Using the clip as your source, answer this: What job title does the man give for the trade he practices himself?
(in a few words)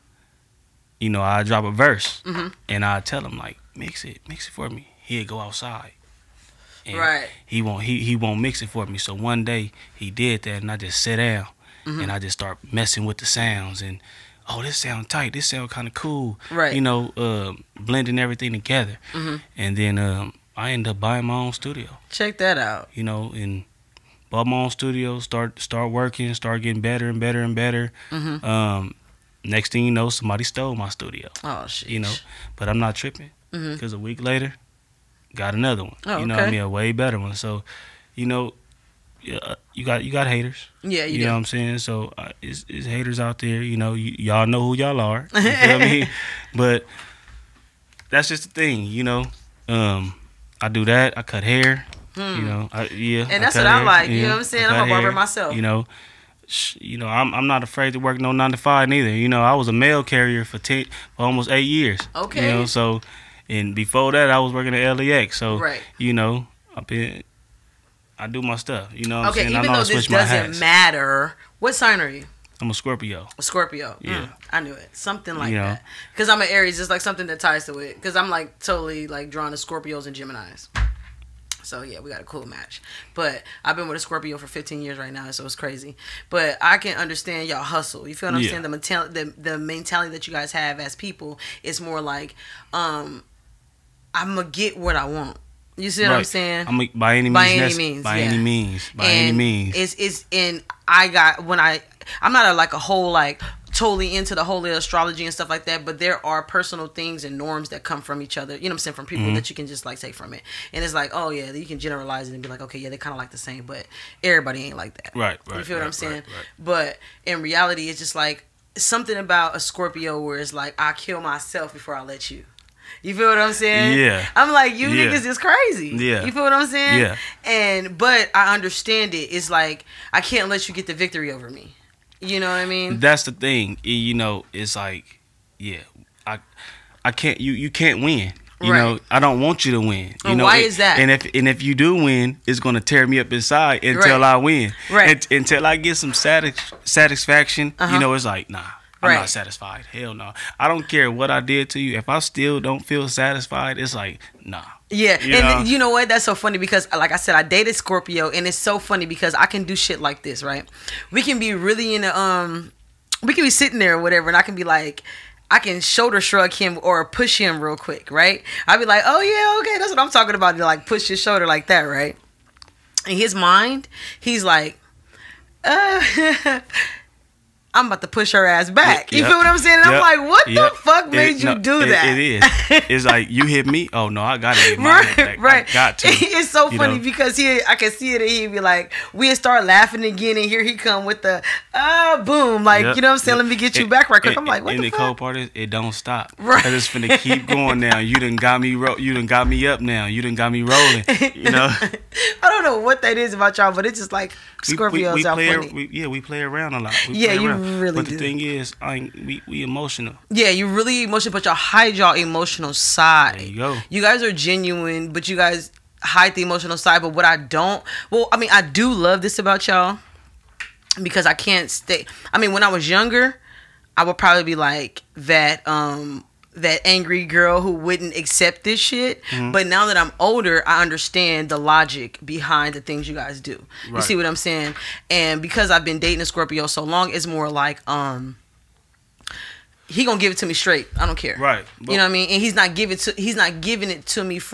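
Barber.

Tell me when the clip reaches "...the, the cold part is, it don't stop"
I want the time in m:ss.
3:14.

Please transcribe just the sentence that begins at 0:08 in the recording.
So one day he did that, and I just sat down mm -hmm.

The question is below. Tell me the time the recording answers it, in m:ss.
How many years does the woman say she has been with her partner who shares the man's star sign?
1:24.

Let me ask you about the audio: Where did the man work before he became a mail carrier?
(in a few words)
LAX.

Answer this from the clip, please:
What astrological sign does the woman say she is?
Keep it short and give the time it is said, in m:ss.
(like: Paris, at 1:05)
Aries, at 1:16.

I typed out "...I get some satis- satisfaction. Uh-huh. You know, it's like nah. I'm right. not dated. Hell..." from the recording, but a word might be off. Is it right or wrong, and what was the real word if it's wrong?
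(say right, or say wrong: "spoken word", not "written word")
wrong: "satisfied", not "dated".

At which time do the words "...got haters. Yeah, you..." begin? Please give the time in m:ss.
0:40.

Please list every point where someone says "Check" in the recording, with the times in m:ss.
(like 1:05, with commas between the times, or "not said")
0:22.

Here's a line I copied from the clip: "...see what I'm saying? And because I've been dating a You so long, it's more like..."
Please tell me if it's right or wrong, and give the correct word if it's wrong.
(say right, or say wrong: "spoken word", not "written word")
wrong: "Scorpio", not "You".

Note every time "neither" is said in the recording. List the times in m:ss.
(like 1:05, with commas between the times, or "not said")
0:58.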